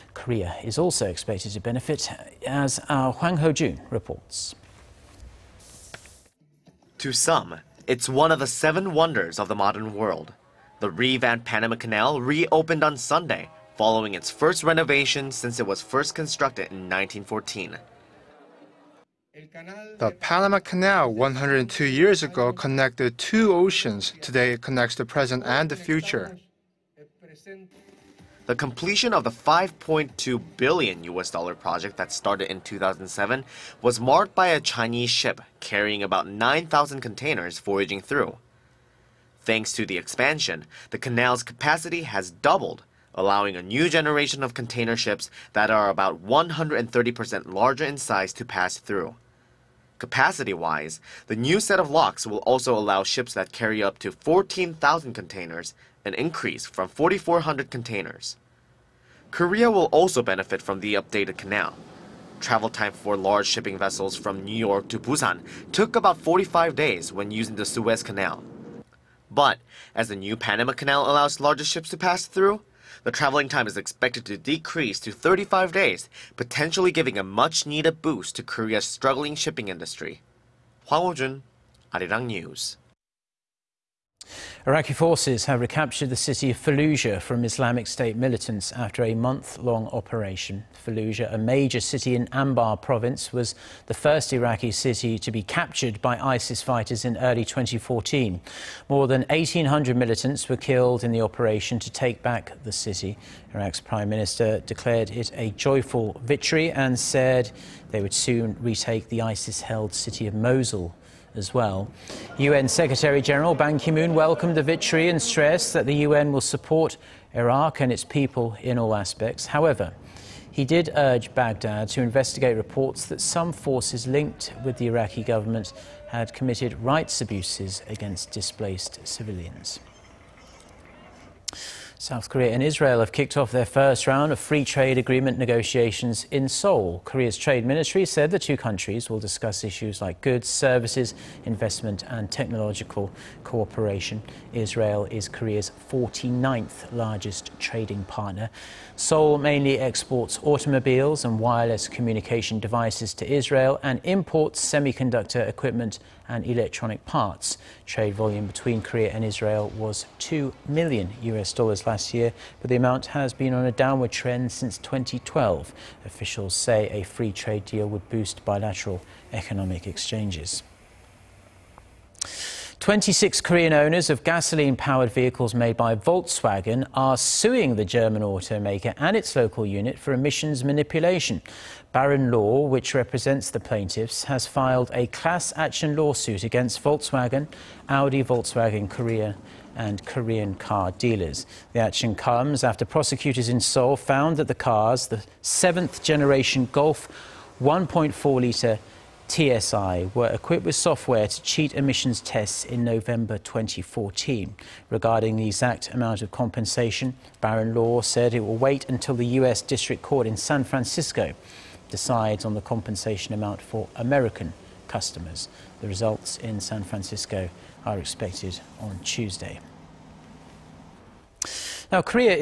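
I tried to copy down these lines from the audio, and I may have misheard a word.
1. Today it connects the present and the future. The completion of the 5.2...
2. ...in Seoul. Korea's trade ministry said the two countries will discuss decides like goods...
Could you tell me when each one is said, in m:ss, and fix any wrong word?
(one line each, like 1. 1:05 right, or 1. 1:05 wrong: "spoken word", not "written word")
1. 0:24 right
2. 2:16 wrong: "issues", not "decides".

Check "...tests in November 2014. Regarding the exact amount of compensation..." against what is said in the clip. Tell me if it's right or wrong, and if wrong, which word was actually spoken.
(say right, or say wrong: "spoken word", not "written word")
right.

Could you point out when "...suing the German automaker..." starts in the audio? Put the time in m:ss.
2:57.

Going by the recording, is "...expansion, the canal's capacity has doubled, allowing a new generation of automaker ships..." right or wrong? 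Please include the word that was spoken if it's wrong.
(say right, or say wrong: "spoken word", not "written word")
wrong: "container", not "automaker".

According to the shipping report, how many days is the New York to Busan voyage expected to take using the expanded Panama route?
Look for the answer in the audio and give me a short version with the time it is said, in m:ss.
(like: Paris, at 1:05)
35 days, at 1:15.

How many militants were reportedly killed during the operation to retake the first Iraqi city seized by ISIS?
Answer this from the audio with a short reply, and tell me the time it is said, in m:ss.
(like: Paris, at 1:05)
More than 1,800, at 1:38.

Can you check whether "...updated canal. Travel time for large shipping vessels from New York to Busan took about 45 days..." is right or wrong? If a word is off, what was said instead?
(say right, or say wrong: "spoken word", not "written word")
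right.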